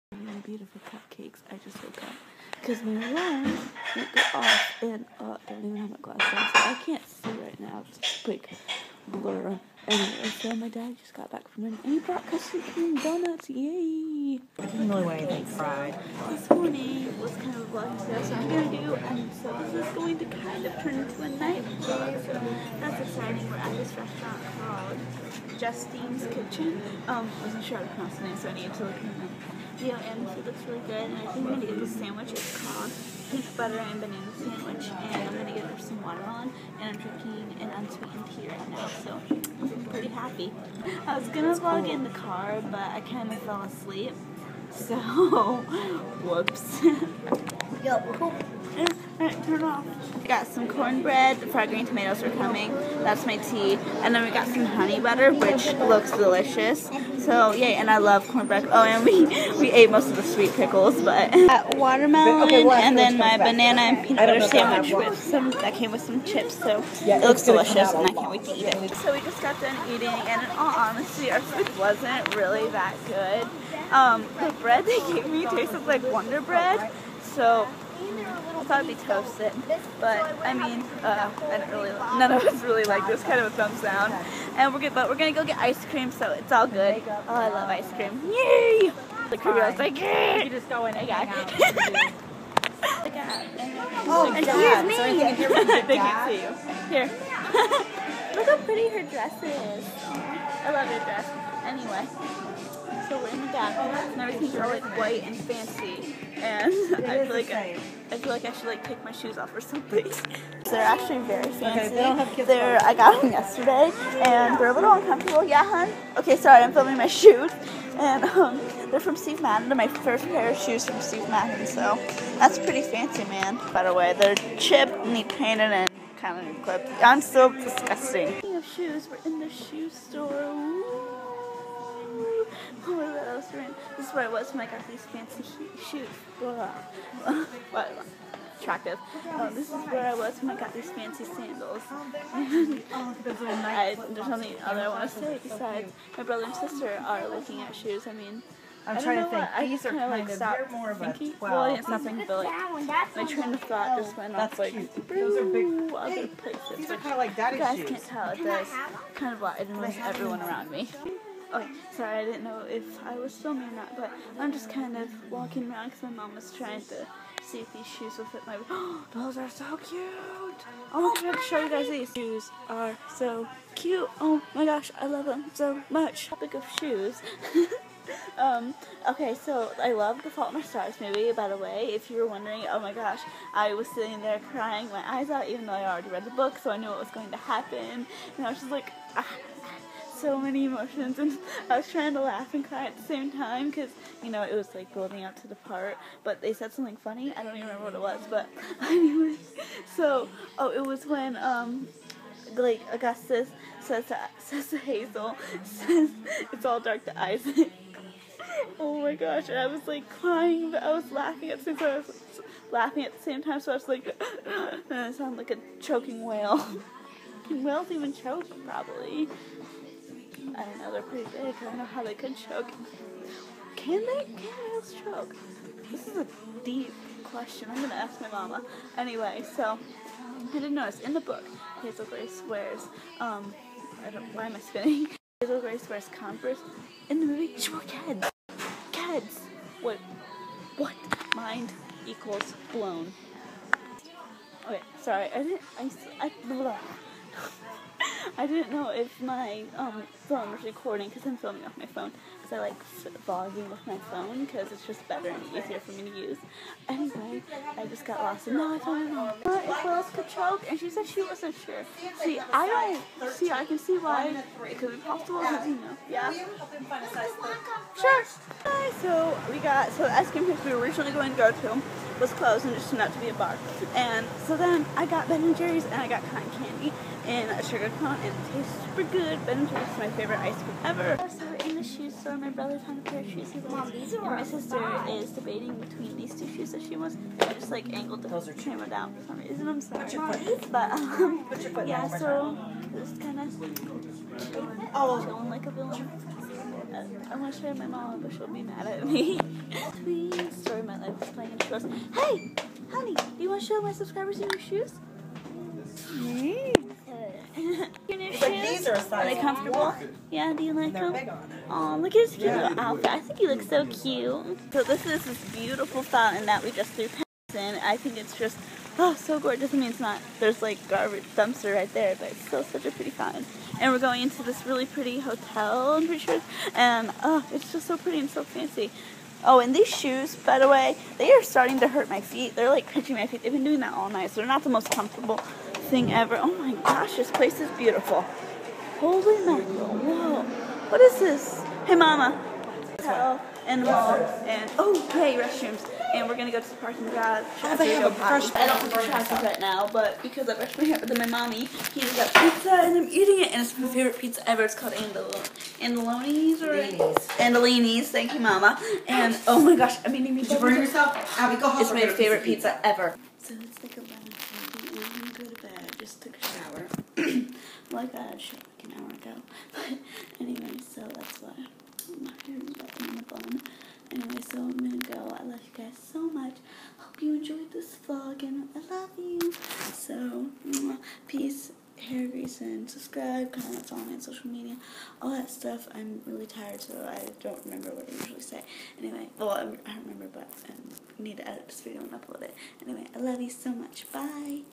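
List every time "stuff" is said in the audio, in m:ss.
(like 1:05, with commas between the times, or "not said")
6:25.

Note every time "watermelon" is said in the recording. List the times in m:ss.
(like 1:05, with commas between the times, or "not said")
0:36, 1:01.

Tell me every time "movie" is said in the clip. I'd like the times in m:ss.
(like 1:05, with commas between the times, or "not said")
3:01, 3:57.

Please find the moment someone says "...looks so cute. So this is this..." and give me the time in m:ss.
5:13.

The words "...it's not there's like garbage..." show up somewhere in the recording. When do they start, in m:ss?
5:19.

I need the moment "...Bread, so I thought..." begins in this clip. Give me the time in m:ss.
1:16.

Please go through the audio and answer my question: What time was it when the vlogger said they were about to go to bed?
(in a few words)
11:30.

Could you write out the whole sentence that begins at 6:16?
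Hope you enjoyed this vlog, and I love you.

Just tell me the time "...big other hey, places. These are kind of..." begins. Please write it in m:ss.
2:35.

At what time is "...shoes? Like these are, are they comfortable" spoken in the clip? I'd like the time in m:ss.
5:08.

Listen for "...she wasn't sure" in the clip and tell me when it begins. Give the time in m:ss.
4:21.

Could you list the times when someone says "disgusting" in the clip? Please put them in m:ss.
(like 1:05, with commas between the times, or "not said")
2:07.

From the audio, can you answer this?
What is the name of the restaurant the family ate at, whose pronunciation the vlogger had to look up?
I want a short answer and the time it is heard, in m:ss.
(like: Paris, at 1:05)
Justine's Kitchen, at 0:25.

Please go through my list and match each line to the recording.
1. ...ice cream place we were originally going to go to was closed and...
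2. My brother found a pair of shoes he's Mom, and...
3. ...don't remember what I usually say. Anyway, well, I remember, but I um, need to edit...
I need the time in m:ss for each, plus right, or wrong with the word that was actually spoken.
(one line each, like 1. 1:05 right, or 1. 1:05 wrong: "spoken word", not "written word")
1. 4:30 right
2. 4:42 right
3. 6:27 right.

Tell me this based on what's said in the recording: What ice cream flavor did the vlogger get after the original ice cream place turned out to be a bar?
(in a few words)
Cotton candy.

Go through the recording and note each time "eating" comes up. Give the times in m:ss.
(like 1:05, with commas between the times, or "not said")
1:09, 5:53.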